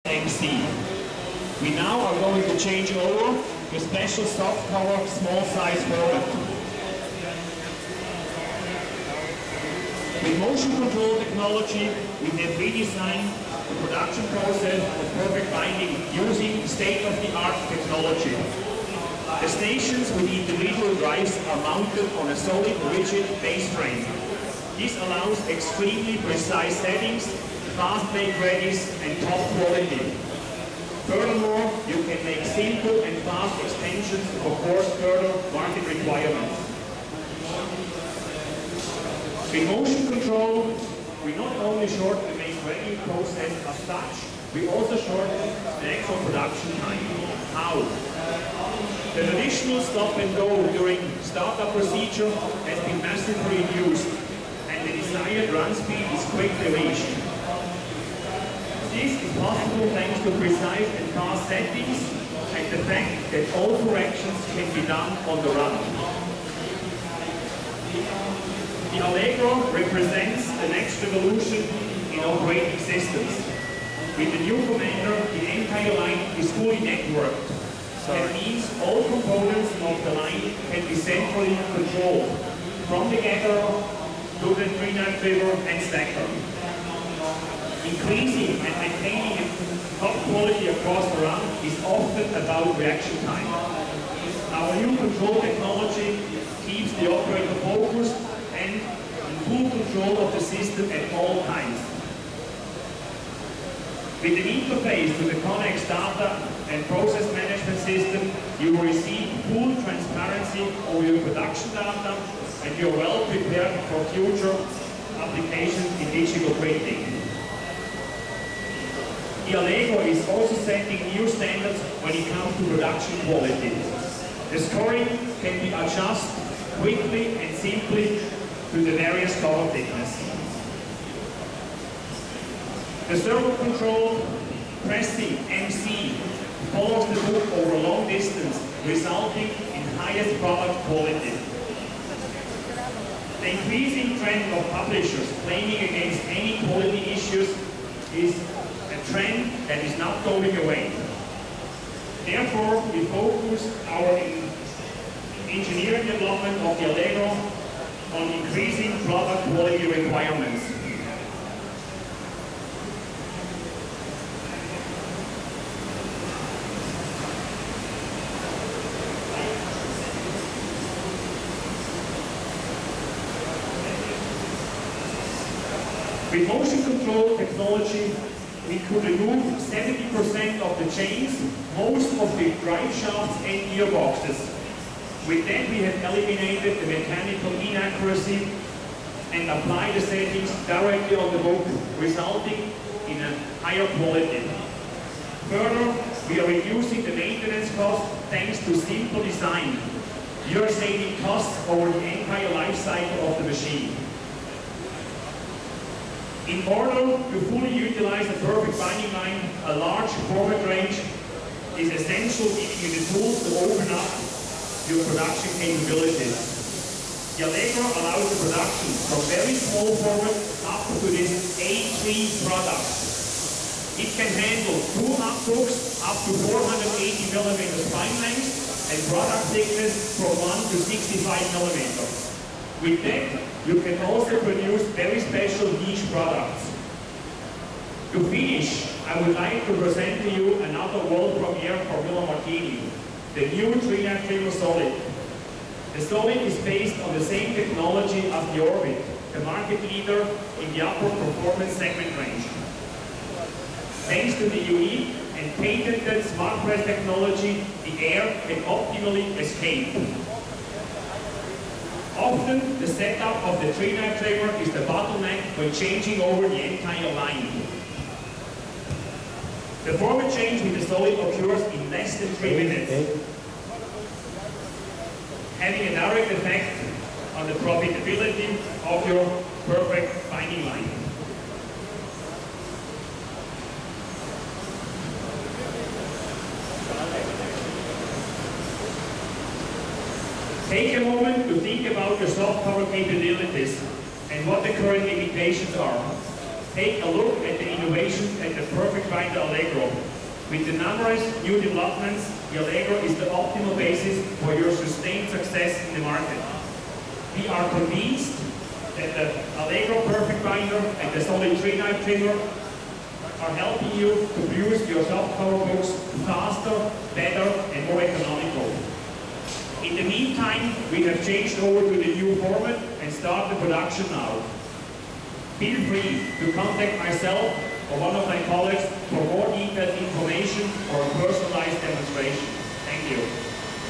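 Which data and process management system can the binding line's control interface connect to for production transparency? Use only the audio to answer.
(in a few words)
Connex.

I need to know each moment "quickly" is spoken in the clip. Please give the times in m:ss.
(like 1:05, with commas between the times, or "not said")
0:56, 2:06.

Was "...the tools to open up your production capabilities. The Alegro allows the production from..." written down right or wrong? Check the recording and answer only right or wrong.
right.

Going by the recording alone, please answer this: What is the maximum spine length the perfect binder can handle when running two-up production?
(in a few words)
480 mm.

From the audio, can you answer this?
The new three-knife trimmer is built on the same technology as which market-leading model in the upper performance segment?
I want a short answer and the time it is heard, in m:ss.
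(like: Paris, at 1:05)
Orbit, at 4:08.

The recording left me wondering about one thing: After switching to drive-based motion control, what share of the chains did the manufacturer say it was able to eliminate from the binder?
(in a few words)
70%.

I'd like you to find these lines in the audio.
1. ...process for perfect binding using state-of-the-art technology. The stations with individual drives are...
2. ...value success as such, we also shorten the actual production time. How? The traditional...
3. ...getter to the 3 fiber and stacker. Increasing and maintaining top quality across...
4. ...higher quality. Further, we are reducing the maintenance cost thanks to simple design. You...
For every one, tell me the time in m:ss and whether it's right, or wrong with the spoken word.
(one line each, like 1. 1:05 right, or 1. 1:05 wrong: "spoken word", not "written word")
1. 0:14 right
2. 0:42 wrong: "process", not "success"
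3. 1:23 right
4. 3:13 right.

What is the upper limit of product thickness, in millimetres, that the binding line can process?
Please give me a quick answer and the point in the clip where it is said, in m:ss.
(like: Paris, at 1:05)
65 mm, at 3:50.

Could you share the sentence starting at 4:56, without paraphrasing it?
Take a look at the innovation at the Perfect Binder Alegro.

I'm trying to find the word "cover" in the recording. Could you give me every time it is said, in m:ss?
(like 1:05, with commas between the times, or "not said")
0:04, 2:09, 4:52, 5:15.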